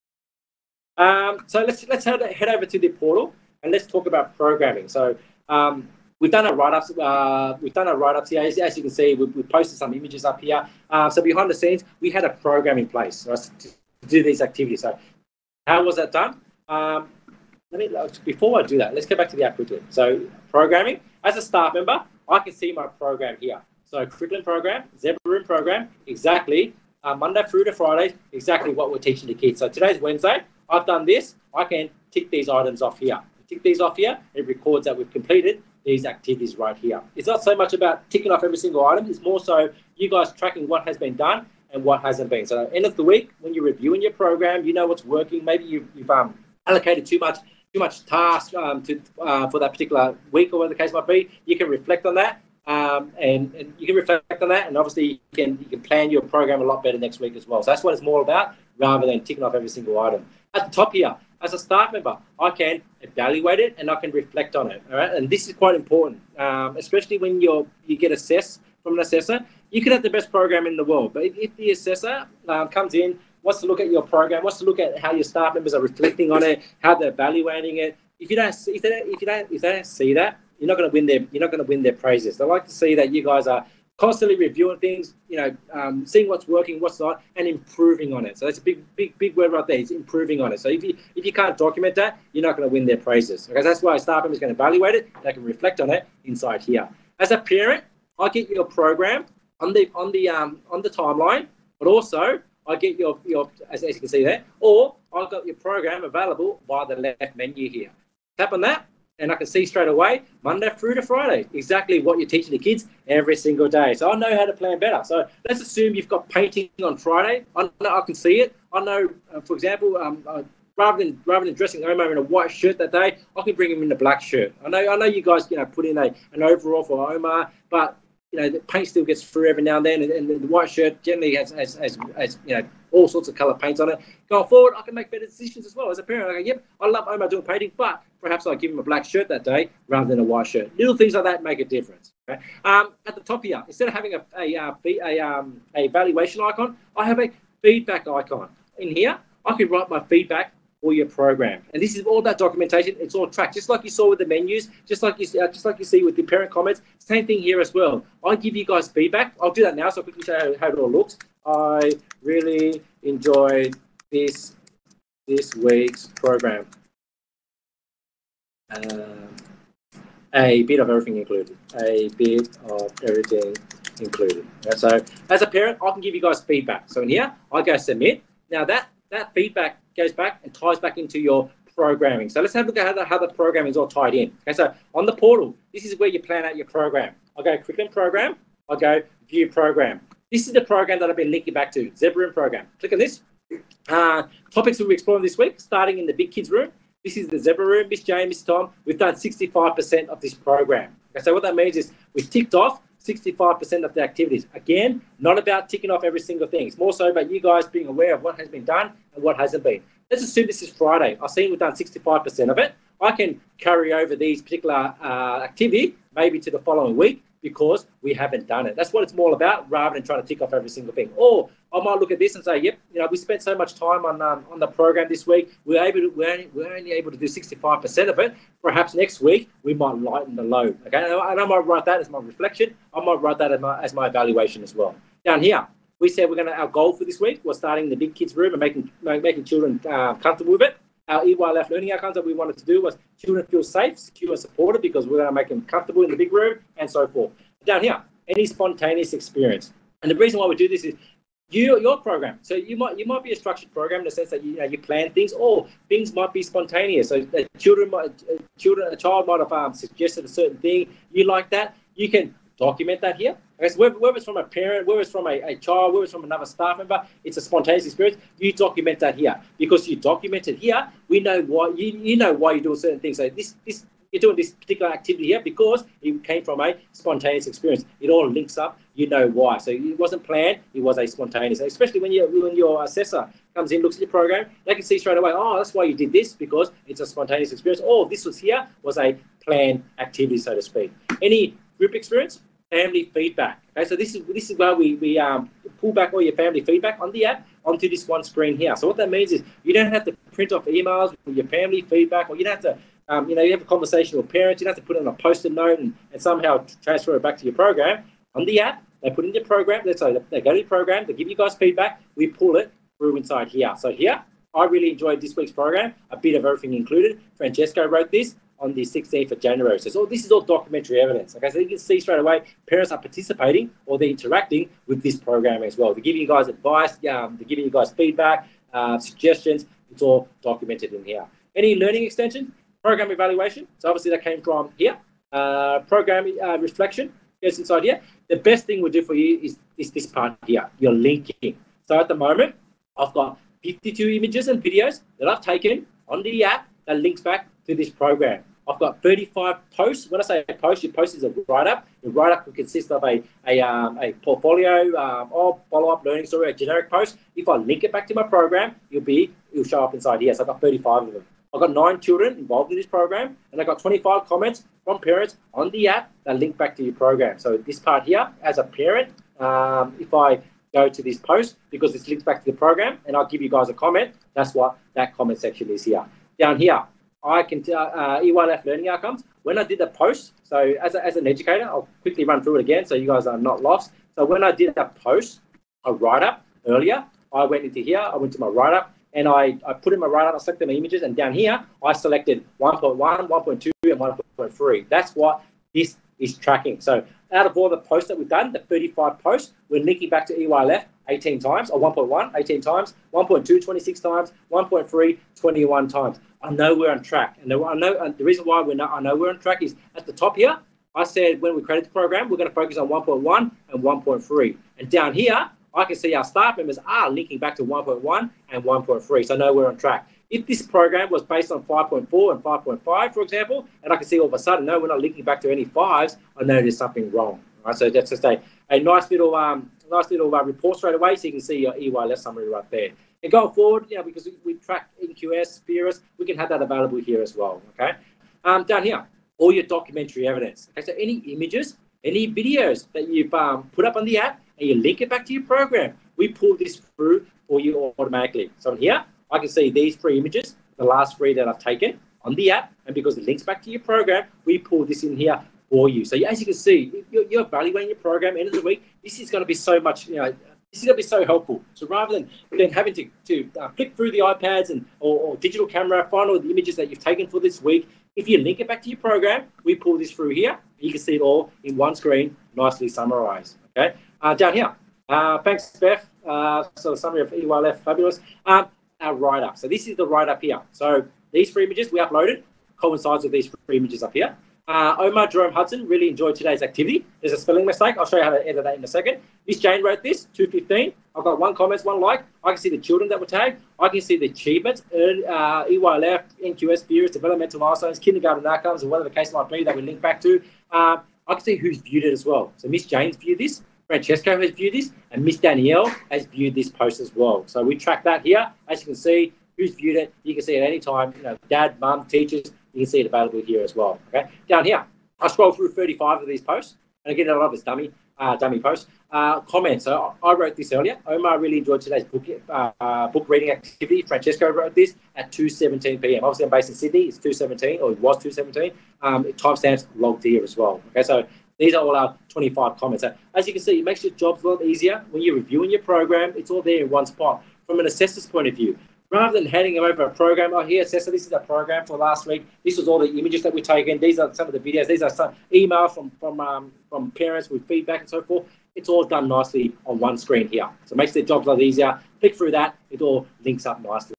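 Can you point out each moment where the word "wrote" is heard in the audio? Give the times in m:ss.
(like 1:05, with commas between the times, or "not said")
5:17, 8:09, 8:40, 8:44.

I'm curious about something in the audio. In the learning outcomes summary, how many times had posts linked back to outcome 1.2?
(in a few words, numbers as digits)
26.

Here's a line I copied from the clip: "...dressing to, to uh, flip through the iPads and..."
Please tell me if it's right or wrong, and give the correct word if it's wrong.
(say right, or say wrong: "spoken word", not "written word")
wrong: "having", not "dressing".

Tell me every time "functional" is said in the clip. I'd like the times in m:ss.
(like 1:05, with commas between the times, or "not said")
not said.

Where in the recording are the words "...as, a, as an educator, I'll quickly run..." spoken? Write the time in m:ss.
6:20.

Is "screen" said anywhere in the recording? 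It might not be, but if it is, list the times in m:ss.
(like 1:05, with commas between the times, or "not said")
4:58, 7:51, 9:10.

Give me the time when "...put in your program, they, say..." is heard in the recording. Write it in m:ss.
5:09.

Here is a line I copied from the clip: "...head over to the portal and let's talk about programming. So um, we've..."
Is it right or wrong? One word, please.
right.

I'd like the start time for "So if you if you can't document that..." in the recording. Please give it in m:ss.
1:30.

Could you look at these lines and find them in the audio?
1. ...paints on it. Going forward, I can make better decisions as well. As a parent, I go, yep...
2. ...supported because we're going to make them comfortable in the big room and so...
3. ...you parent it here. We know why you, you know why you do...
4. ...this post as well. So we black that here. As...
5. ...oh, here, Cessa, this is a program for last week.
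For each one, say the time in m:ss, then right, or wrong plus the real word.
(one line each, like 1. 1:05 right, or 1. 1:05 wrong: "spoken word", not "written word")
1. 2:13 right
2. 4:04 right
3. 4:29 wrong: "document", not "parent"
4. 8:26 wrong: "track", not "black"
5. 9:00 right.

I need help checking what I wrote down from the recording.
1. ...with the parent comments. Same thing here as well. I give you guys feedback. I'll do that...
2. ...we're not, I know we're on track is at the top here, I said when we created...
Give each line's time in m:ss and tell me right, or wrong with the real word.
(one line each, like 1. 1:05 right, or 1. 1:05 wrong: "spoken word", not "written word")
1. 2:36 right
2. 6:48 right.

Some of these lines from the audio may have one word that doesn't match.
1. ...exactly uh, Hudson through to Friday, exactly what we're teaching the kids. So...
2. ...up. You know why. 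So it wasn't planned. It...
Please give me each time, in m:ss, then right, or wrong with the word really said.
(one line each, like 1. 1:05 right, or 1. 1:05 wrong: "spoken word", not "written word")
1. 0:26 wrong: "Monday", not "Hudson"
2. 4:38 right.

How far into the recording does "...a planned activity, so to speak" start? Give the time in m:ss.
4:48.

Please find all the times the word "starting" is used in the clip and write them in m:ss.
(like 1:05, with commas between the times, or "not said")
3:15, 3:57.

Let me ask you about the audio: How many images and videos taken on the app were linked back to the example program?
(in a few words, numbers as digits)
52.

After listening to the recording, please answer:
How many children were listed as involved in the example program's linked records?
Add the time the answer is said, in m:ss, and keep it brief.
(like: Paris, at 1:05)
nine, at 6:01.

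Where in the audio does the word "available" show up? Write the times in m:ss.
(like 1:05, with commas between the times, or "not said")
1:46, 7:16, 8:33.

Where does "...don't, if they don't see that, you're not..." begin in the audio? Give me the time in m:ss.
1:19.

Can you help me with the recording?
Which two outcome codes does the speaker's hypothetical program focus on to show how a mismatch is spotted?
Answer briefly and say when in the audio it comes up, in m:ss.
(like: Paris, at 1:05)
5.4 and 5.5, at 7:01.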